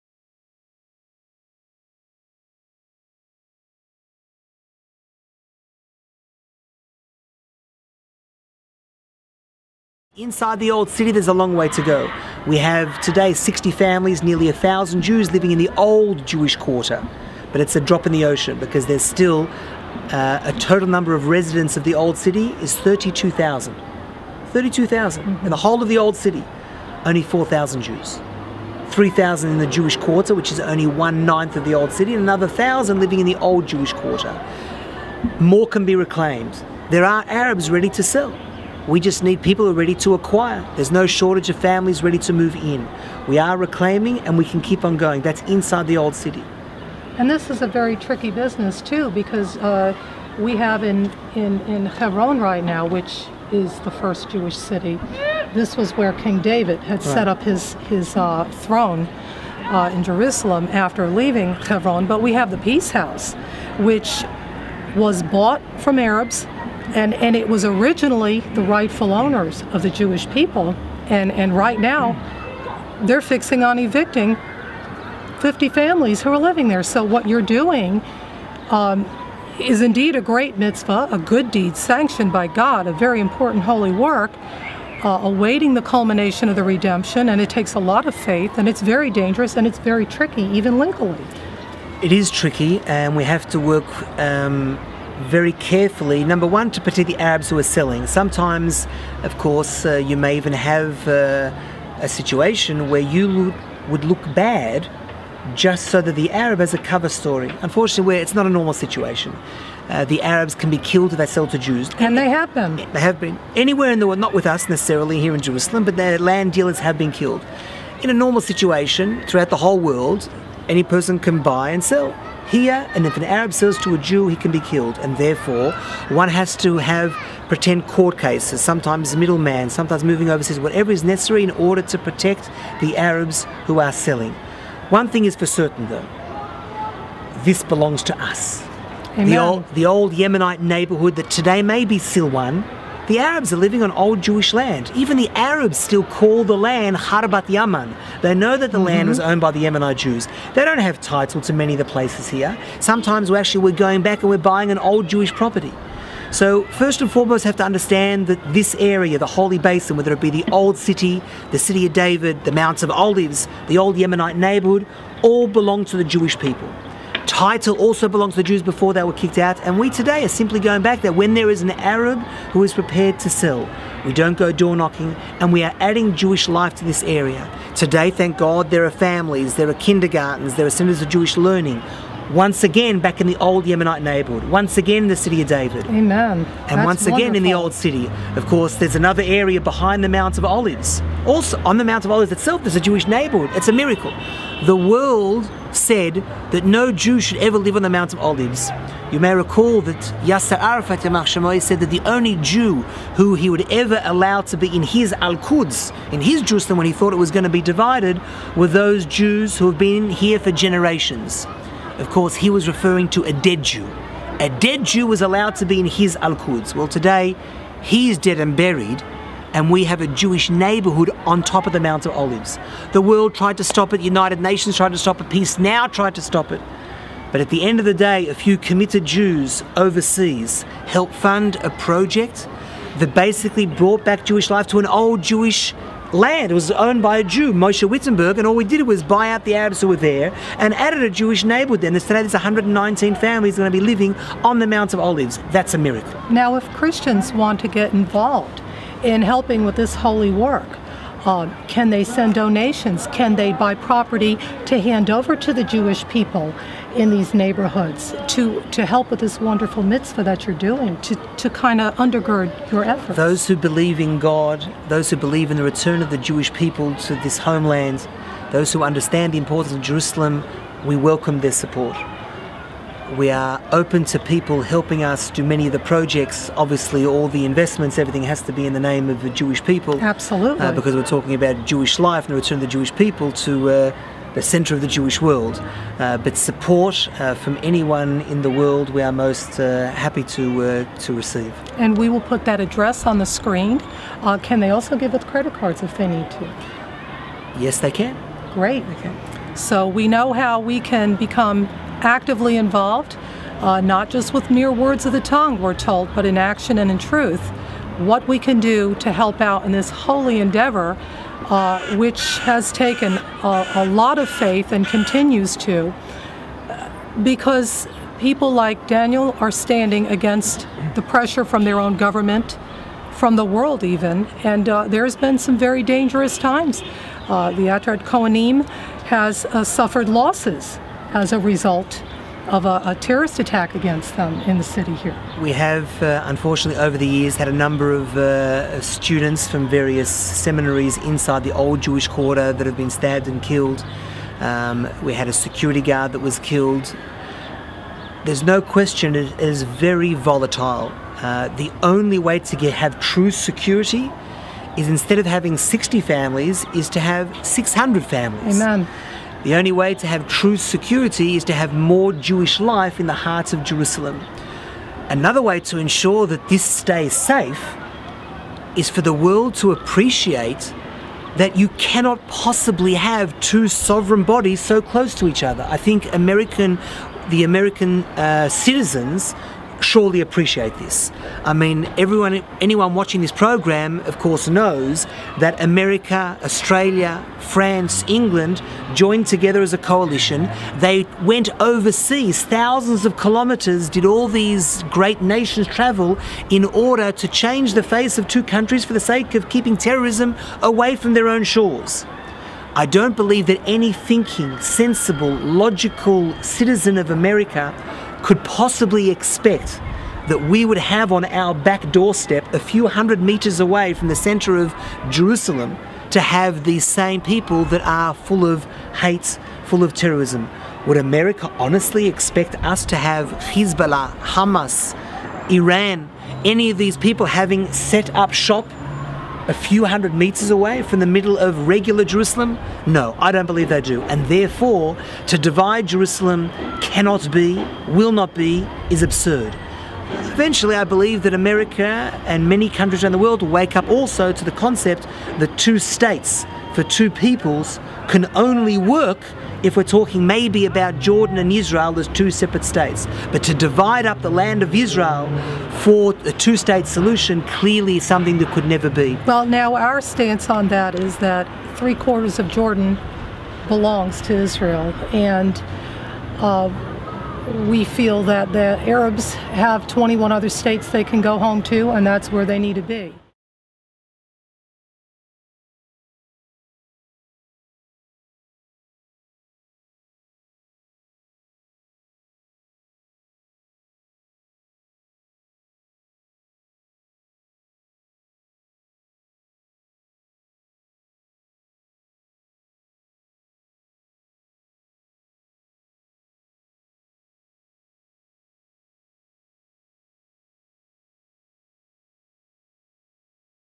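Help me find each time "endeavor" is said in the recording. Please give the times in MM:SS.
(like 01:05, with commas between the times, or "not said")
05:10.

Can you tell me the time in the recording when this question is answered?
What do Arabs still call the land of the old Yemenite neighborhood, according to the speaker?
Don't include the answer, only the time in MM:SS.
02:26.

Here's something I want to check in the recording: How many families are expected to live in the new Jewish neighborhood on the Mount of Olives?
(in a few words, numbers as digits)
119.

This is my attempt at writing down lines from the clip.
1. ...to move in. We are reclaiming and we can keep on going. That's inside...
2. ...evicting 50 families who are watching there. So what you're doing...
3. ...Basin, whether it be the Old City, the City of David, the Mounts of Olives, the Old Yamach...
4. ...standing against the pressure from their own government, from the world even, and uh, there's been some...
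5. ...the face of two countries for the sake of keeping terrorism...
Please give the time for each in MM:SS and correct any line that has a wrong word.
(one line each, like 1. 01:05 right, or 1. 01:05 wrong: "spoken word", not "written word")
1. 00:42 right
2. 01:13 wrong: "living", not "watching"
3. 02:39 wrong: "Yemenite", not "Yamach"
4. 05:19 right
5. 06:37 right.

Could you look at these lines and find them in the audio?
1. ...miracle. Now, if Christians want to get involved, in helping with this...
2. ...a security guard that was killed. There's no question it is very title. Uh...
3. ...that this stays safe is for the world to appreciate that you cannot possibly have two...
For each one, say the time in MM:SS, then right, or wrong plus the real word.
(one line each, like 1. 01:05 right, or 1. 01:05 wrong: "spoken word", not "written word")
1. 04:05 right
2. 05:45 wrong: "volatile", not "title"
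3. 06:06 right.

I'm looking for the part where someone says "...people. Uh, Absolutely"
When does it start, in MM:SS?
04:39.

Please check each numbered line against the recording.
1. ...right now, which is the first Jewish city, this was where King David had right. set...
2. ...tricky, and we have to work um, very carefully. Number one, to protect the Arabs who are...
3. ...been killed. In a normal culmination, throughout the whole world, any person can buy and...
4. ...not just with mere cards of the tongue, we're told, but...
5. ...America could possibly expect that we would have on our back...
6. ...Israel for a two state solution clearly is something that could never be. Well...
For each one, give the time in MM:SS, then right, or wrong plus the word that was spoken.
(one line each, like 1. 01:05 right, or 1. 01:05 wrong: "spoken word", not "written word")
1. 00:52 right
2. 01:32 right
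3. 01:56 wrong: "situation", not "culmination"
4. 05:03 wrong: "words", not "cards"
5. 06:47 right
6. 07:34 right.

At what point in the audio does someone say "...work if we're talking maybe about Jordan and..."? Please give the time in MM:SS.
07:28.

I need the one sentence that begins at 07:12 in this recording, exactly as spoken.
No, I don't believe they do.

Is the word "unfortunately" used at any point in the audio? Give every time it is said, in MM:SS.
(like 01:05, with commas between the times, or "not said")
01:47, 05:36.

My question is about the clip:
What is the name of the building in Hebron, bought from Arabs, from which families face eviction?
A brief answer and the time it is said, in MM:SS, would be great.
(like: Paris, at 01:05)
Peace House, at 01:02.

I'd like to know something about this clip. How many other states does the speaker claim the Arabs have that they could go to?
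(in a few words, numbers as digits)
21.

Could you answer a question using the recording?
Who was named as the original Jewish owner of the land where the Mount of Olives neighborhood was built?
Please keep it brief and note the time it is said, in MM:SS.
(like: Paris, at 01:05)
Moshe Wittenberg, at 03:57.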